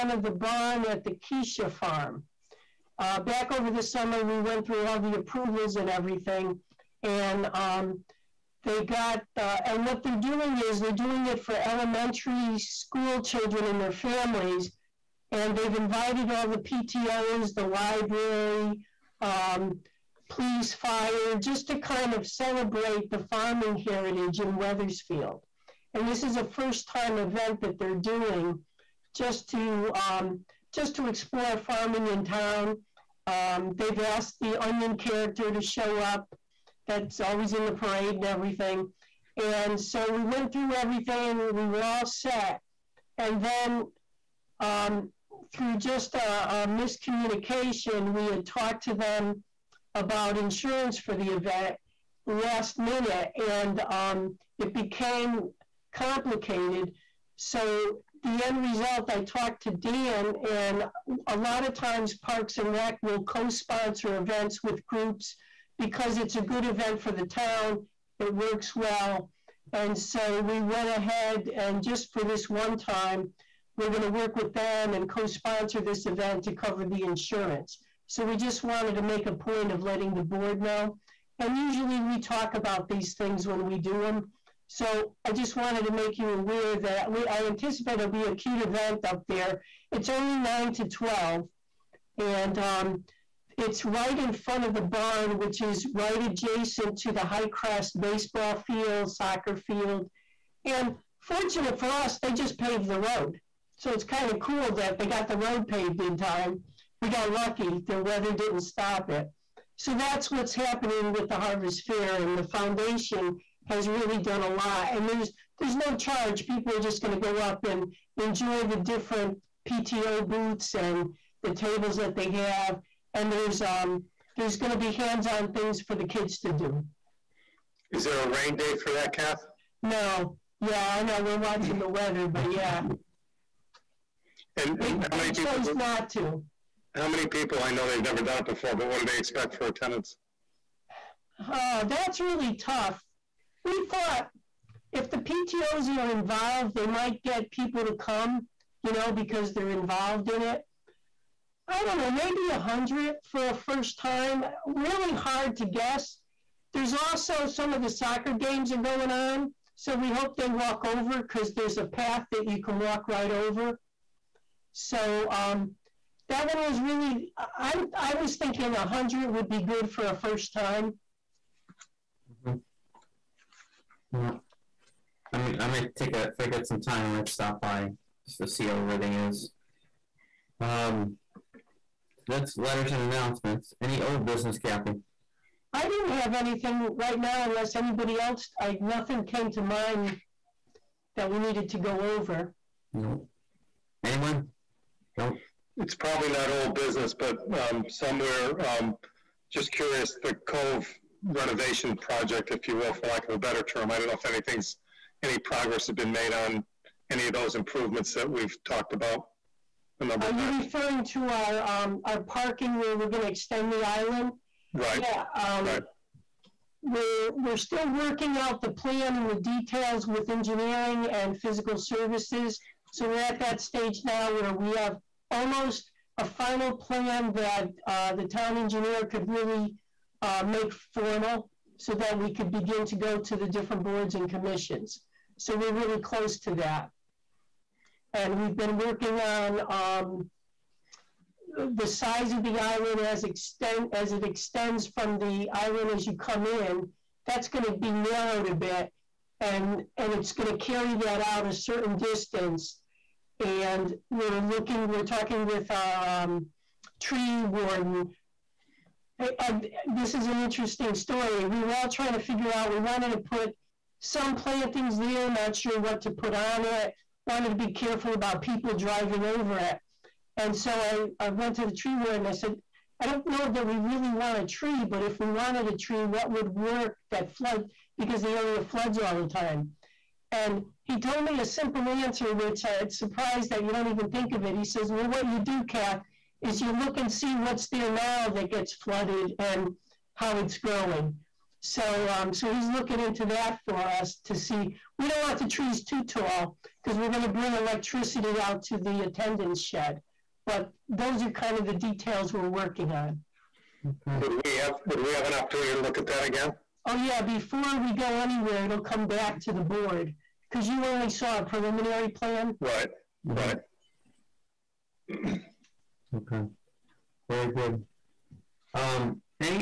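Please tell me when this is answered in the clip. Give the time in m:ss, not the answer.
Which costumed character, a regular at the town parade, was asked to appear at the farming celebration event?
0:34.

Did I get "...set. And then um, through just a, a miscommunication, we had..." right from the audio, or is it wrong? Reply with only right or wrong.
right.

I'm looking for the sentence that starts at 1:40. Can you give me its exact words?
And fortunate for us, they just paved the road.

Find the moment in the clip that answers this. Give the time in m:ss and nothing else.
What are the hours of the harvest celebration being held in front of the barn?
1:30.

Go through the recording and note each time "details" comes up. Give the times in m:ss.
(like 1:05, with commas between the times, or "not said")
3:39, 5:01.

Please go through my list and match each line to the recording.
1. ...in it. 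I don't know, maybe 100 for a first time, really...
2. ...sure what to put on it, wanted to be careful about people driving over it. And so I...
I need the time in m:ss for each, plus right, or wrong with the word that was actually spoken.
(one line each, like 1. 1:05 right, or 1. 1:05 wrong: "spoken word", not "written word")
1. 2:30 right
2. 4:25 right.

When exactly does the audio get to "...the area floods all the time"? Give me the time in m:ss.
4:38.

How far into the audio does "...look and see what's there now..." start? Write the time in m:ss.
4:46.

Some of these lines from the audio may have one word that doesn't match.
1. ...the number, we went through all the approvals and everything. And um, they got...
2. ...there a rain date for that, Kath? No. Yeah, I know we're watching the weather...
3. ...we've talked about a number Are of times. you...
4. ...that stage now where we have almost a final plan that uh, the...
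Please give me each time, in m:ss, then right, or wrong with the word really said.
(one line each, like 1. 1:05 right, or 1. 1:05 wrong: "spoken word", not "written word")
1. 0:03 wrong: "summer", not "number"
2. 2:08 right
3. 3:28 right
4. 3:43 right.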